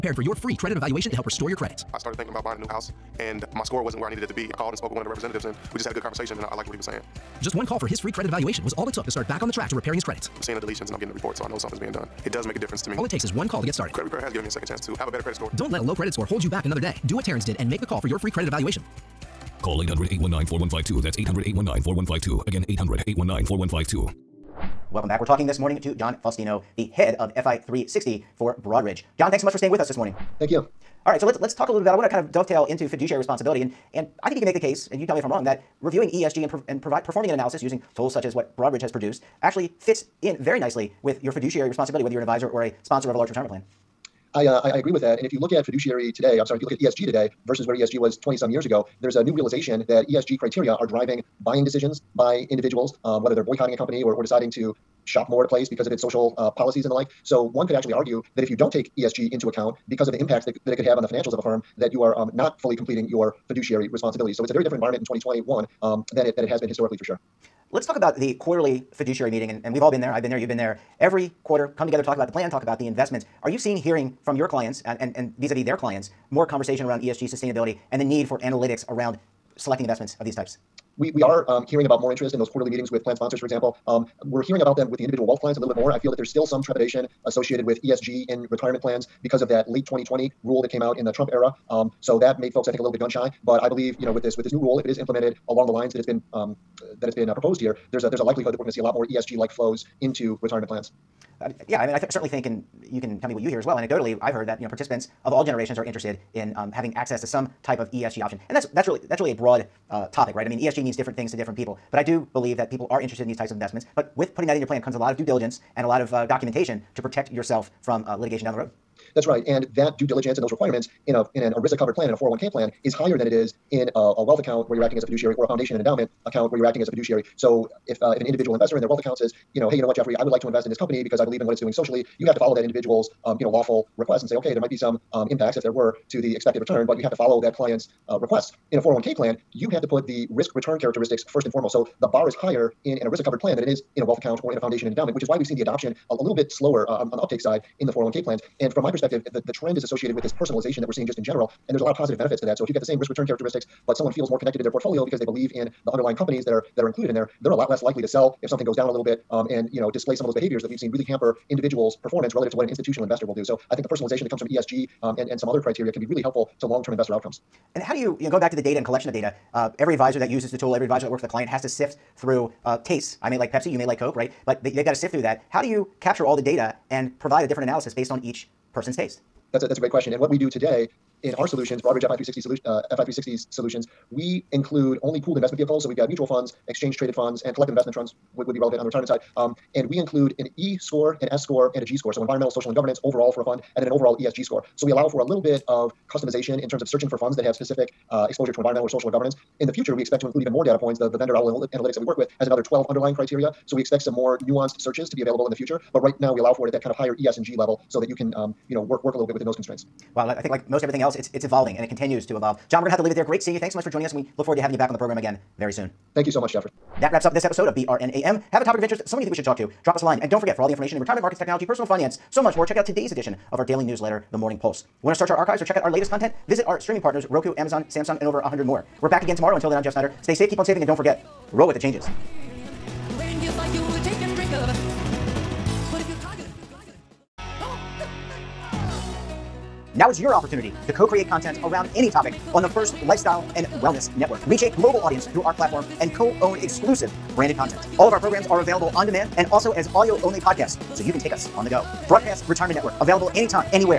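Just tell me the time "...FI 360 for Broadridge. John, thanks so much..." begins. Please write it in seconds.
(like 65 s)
27 s.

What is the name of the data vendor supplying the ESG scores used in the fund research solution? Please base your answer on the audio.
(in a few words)
Owl Analytics.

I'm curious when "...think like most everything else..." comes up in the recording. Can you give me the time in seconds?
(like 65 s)
210 s.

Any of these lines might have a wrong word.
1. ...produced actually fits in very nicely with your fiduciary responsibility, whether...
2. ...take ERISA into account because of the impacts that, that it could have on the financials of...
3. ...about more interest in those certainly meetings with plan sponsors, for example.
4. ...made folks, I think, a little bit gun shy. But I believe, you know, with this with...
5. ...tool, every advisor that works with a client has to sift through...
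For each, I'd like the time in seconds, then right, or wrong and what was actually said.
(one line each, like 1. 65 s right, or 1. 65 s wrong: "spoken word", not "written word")
1. 38 s right
2. 58 s wrong: "ESG", not "ERISA"
3. 81 s wrong: "quarterly", not "certainly"
4. 92 s right
5. 170 s right.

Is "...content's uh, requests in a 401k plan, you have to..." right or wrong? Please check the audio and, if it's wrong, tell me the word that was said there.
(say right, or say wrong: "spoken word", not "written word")
wrong: "client", not "content".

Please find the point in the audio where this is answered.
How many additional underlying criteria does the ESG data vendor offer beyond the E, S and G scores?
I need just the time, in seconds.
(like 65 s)
202 s.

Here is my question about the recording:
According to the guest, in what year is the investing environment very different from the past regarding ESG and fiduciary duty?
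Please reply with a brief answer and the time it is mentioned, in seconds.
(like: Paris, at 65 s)
2021, at 65 s.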